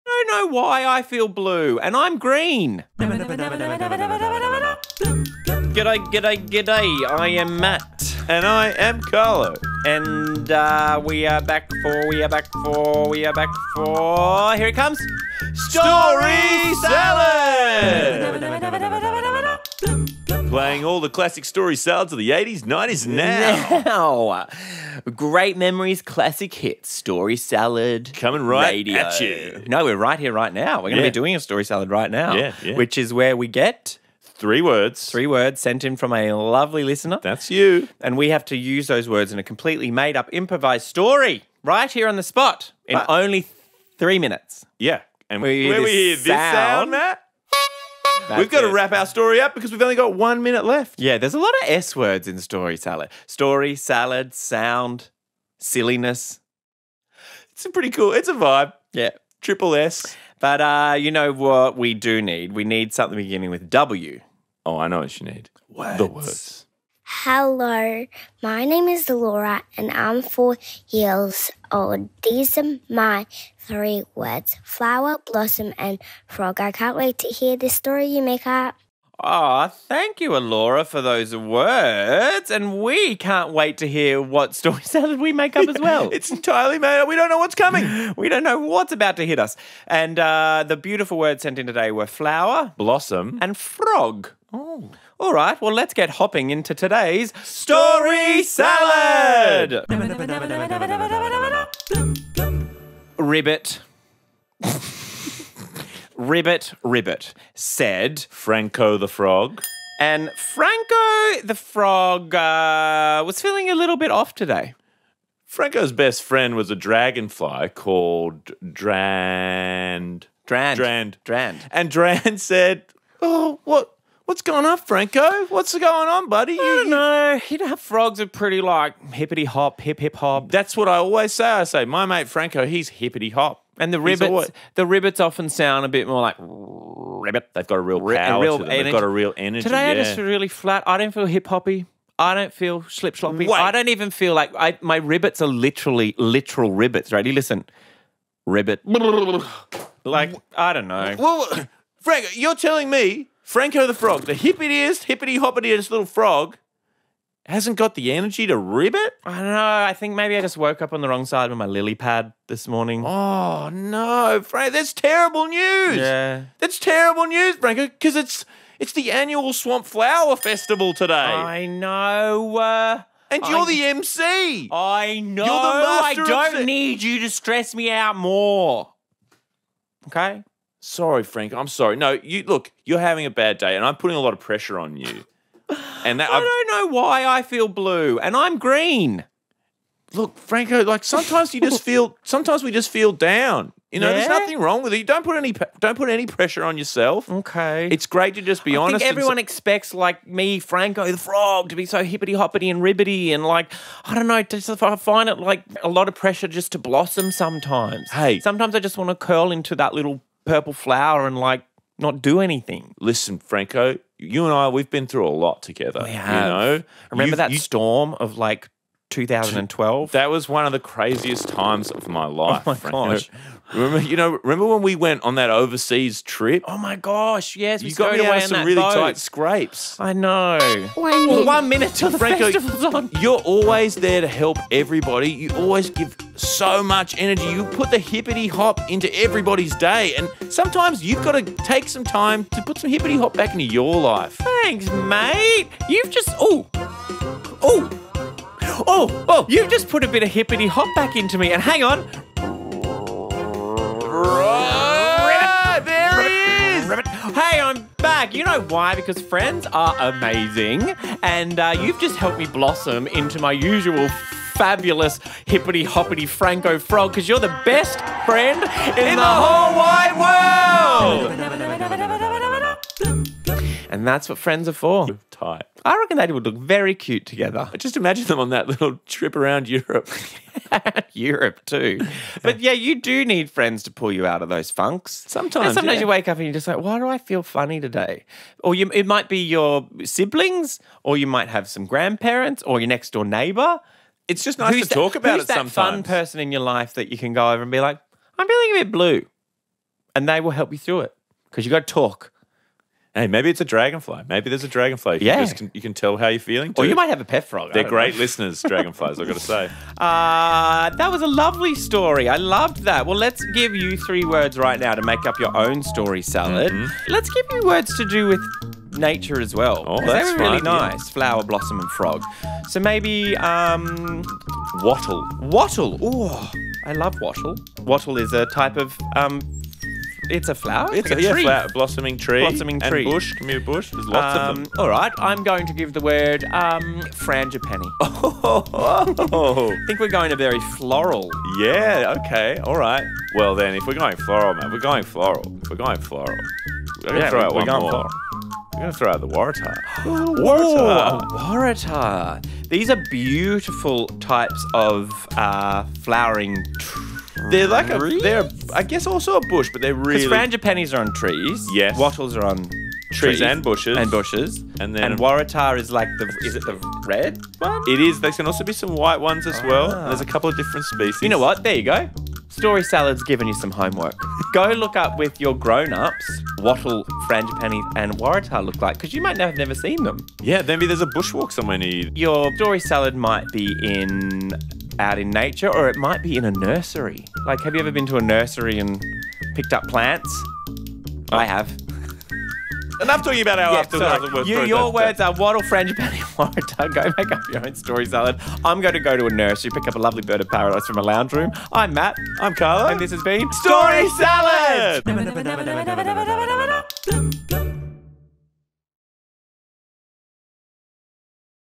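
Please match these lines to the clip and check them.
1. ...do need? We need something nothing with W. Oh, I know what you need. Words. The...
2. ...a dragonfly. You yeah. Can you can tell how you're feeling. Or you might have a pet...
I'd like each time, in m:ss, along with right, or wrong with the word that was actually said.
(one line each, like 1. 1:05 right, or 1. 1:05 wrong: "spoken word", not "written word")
1. 1:01 wrong: "beginning", not "nothing"
2. 5:04 right.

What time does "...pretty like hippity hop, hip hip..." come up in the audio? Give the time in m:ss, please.
2:08.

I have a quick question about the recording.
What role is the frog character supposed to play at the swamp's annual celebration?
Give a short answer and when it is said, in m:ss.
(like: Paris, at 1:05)
The MC, at 2:53.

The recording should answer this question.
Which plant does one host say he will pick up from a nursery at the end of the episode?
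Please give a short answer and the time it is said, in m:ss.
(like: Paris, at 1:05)
Bird of paradise, at 6:40.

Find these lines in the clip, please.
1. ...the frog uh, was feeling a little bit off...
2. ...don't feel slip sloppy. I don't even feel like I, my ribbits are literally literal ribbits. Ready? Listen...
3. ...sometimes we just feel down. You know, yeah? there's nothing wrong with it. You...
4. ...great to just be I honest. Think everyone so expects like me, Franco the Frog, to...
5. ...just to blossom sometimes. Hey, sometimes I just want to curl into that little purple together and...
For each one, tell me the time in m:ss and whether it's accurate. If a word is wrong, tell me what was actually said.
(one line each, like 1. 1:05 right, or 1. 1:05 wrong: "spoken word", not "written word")
1. 1:51 right
2. 2:22 right
3. 3:12 right
4. 3:18 right
5. 3:26 wrong: "flower", not "together".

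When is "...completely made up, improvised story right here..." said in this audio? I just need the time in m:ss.
0:39.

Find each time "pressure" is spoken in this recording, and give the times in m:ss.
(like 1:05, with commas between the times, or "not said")
3:04, 3:16, 3:26.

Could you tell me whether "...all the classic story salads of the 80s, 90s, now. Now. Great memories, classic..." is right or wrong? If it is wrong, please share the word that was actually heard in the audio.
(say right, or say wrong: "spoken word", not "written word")
right.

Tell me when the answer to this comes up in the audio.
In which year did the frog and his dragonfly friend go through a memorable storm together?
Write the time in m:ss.
3:39.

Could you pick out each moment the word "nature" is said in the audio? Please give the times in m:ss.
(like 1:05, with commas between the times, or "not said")
5:18, 6:25.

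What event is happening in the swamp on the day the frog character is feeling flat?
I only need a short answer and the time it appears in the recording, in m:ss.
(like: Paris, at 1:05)
Swamp Flower Festival, at 2:49.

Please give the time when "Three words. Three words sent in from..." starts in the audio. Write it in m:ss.
0:34.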